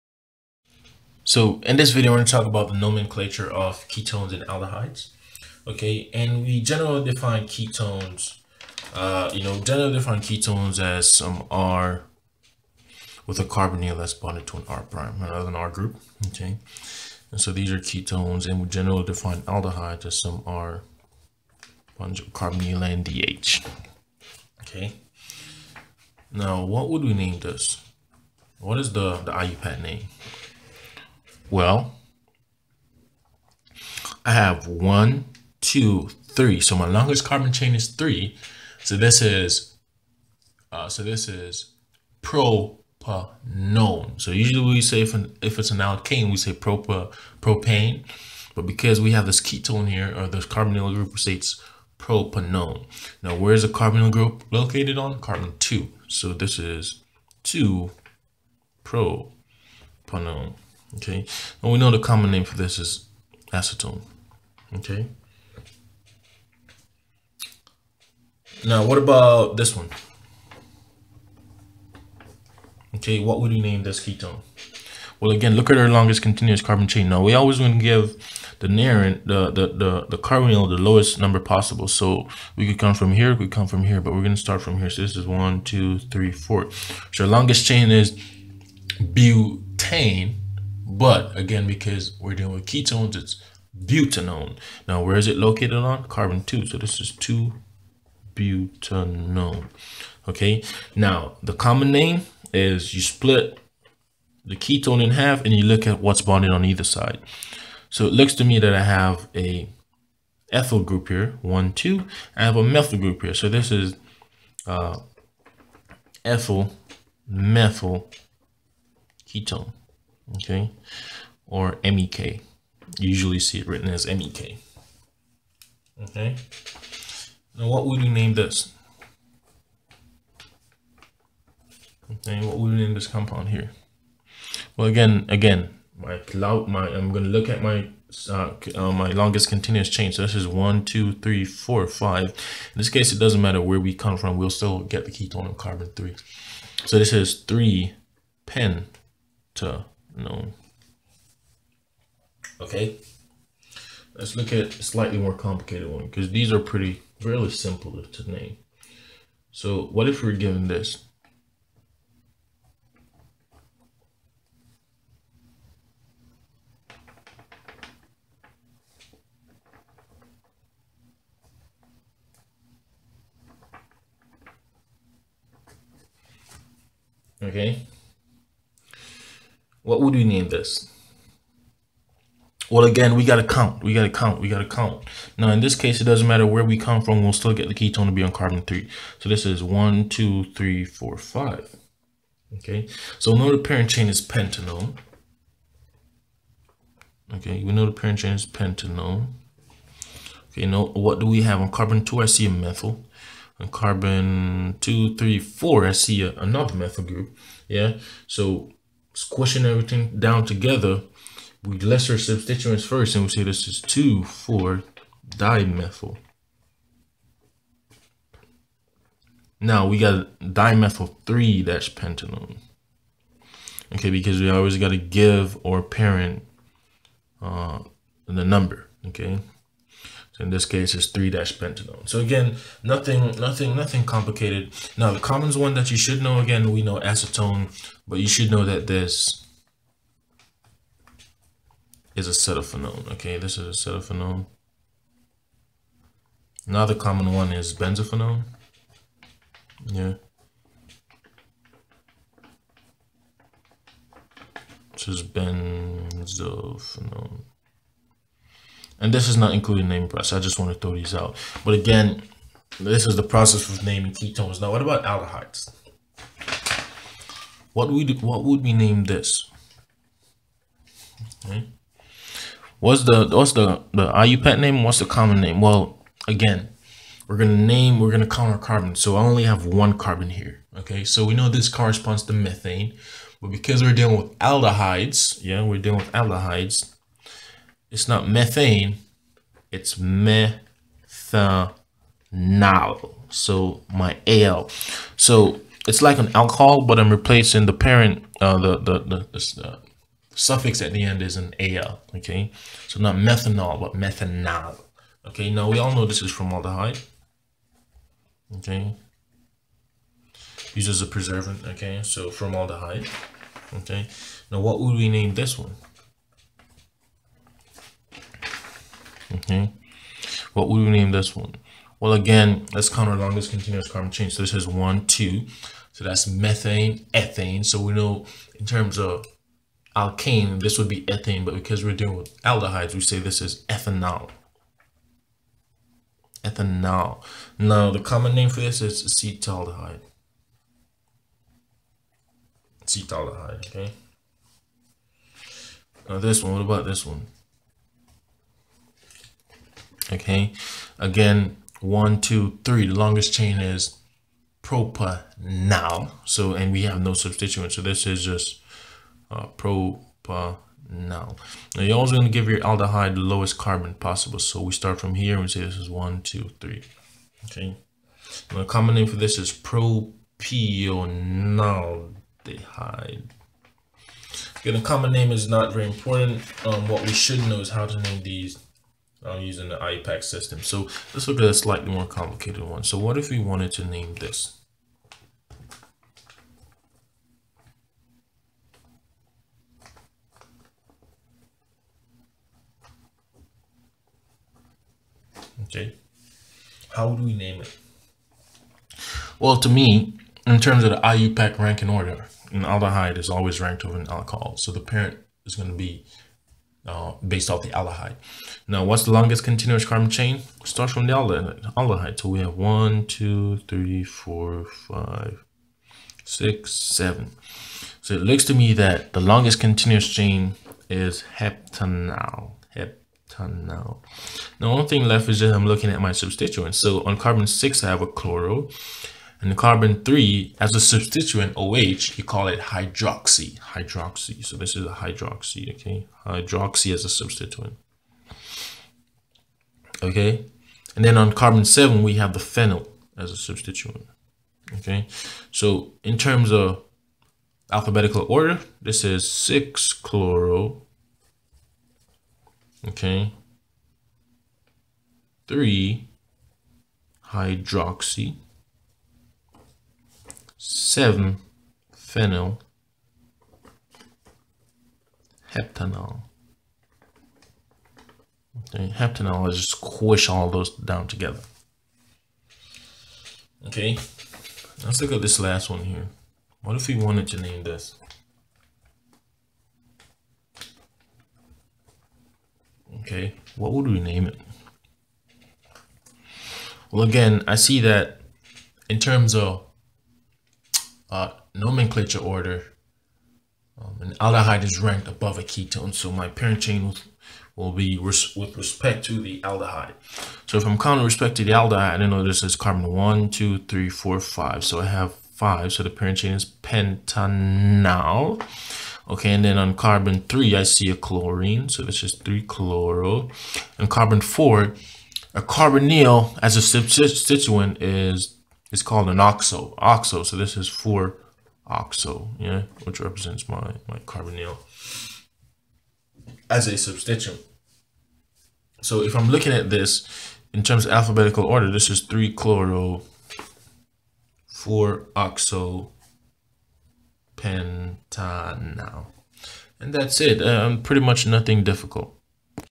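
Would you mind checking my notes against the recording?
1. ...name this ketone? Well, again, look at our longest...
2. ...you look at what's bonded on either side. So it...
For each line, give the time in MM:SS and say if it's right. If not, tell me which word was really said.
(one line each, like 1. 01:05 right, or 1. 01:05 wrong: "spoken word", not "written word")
1. 01:13 right
2. 01:45 right.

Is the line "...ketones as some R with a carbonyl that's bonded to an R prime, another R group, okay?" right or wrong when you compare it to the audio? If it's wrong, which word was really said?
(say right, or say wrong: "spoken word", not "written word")
right.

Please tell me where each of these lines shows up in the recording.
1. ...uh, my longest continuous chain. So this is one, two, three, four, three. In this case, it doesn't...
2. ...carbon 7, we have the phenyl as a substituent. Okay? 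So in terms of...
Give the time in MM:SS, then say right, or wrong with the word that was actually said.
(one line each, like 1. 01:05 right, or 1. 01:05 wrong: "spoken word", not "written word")
1. 02:18 wrong: "five", not "three"
2. 07:21 right.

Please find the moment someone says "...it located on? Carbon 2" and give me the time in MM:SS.
01:35.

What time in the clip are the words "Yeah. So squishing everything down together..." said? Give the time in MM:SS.
03:27.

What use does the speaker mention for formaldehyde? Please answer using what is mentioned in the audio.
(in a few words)
preservative.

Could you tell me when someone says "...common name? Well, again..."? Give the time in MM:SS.
04:35.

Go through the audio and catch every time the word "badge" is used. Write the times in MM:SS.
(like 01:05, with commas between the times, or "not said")
not said.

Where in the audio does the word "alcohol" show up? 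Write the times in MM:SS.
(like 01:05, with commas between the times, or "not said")
04:56, 06:44.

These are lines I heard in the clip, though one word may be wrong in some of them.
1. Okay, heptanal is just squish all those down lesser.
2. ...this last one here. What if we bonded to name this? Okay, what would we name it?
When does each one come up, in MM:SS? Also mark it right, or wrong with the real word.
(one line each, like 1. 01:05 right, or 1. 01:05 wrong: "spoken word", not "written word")
1. 07:48 wrong: "together", not "lesser"
2. 07:55 wrong: "wanted", not "bonded".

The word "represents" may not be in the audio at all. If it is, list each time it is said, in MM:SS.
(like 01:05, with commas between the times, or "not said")
08:43.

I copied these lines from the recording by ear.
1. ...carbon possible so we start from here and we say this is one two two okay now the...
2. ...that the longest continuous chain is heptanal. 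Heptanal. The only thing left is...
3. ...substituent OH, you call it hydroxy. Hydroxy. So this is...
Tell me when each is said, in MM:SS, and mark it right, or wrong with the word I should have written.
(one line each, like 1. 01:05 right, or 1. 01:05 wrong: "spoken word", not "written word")
1. 06:03 wrong: "three", not "two"
2. 06:58 right
3. 07:10 right.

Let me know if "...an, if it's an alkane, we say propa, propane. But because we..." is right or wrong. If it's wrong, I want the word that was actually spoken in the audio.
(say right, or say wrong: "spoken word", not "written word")
right.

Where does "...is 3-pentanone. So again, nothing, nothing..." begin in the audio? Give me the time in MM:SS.
03:50.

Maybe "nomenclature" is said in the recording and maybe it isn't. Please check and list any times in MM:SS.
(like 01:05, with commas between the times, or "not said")
00:02, 08:11.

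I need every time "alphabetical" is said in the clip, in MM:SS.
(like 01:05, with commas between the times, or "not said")
07:27, 08:50.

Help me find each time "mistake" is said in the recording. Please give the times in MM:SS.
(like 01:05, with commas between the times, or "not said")
not said.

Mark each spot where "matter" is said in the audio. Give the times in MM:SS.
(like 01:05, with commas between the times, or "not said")
02:23, 03:06.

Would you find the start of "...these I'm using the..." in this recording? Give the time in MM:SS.
06:18.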